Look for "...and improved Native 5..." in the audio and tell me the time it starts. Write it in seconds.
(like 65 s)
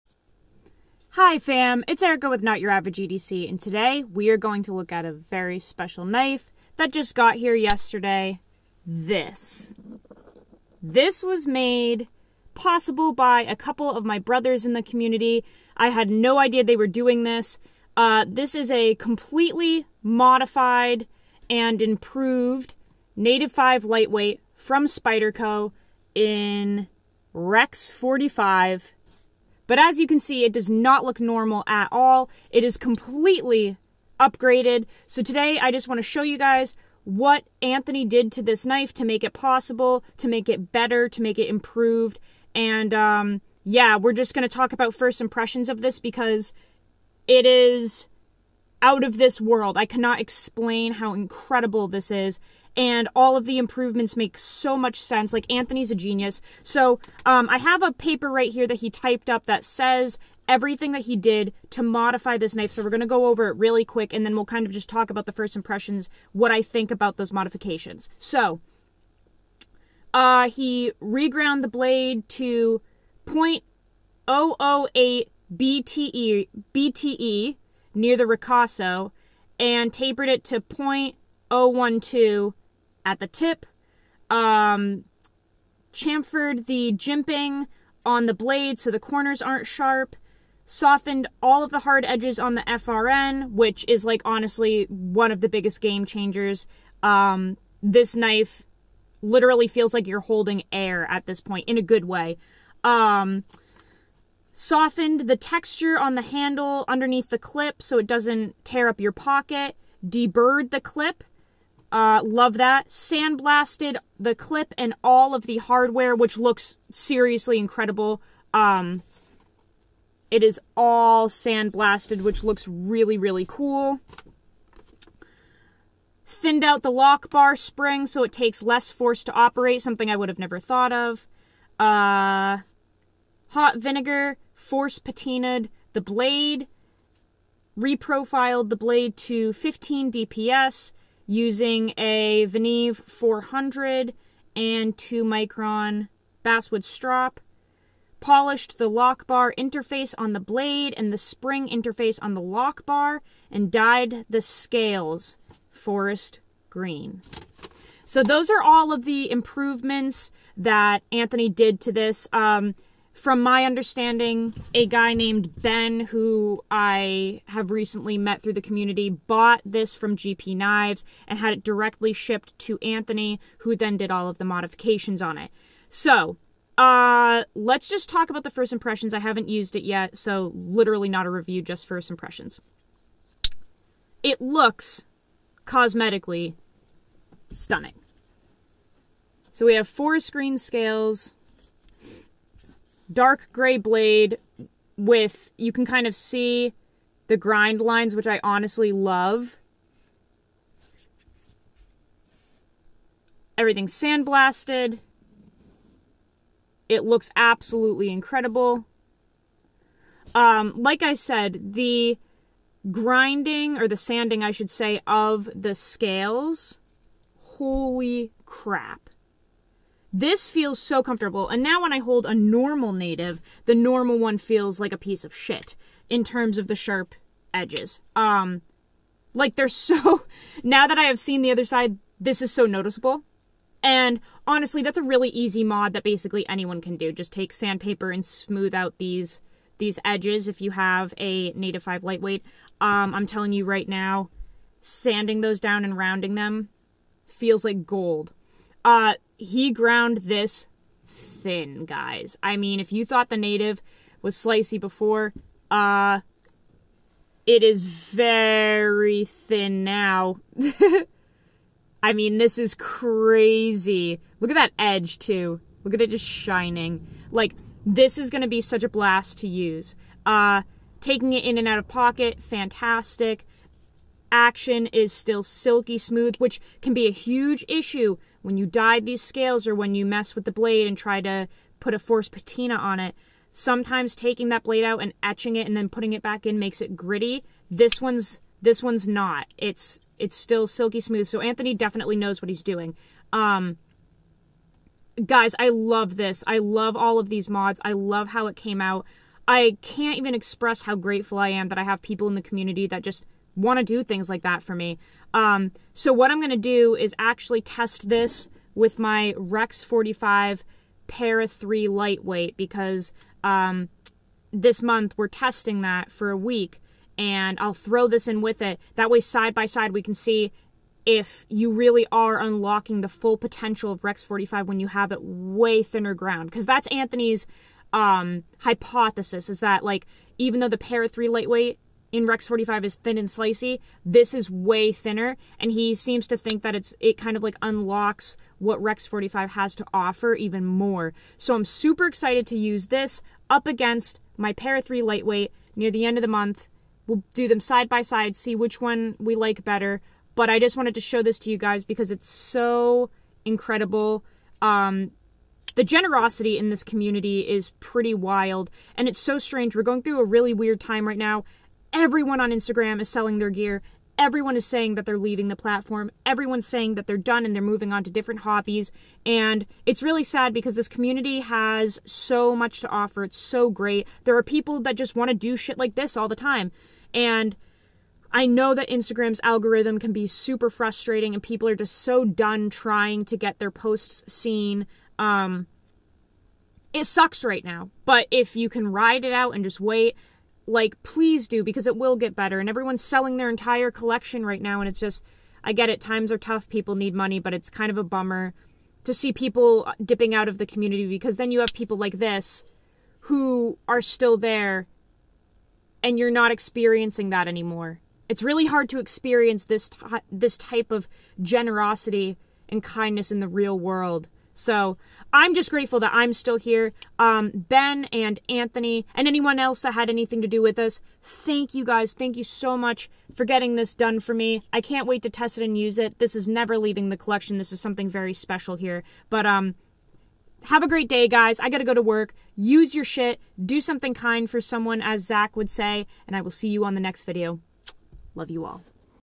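21 s.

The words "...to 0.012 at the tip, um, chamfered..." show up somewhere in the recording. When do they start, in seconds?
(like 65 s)
80 s.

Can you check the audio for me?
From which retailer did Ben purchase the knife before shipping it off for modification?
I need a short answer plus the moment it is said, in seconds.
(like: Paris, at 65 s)
GP Knives, at 170 s.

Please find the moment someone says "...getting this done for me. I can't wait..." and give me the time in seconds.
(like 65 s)
423 s.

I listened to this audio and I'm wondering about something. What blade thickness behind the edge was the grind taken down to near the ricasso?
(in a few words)
0.008.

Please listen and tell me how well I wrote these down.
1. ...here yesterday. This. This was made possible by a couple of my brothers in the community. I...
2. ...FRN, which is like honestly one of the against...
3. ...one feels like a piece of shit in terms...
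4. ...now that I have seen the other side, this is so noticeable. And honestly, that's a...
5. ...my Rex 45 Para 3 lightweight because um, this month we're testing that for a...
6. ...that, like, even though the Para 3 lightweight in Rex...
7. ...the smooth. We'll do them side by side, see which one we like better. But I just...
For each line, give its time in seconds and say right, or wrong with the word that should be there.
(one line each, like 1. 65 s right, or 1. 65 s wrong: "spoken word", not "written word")
1. 7 s right
2. 92 s wrong: "biggest", not "against"
3. 224 s right
4. 230 s right
5. 308 s right
6. 329 s right
7. 346 s wrong: "month", not "smooth".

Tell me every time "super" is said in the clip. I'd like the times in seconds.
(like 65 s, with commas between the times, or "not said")
341 s, 380 s.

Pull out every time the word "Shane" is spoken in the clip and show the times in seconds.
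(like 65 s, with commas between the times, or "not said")
not said.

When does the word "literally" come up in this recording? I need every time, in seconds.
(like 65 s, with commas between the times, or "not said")
99 s, 180 s.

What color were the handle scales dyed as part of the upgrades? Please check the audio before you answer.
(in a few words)
forest green.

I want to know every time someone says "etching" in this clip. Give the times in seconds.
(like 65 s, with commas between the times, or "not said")
285 s.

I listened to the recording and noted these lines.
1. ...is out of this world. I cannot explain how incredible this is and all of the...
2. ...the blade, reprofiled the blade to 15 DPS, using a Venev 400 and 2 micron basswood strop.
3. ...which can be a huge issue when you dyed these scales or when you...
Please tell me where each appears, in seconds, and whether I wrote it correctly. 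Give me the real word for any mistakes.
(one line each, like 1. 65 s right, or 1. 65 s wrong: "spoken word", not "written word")
1. 47 s right
2. 135 s right
3. 276 s right.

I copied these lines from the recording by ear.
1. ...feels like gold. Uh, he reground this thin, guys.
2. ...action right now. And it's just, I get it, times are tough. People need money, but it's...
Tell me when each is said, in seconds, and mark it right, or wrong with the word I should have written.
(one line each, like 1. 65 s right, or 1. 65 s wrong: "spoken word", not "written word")
1. 247 s wrong: "ground", not "reground"
2. 393 s wrong: "collection", not "action".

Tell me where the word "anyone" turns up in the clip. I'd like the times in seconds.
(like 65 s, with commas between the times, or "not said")
236 s, 419 s.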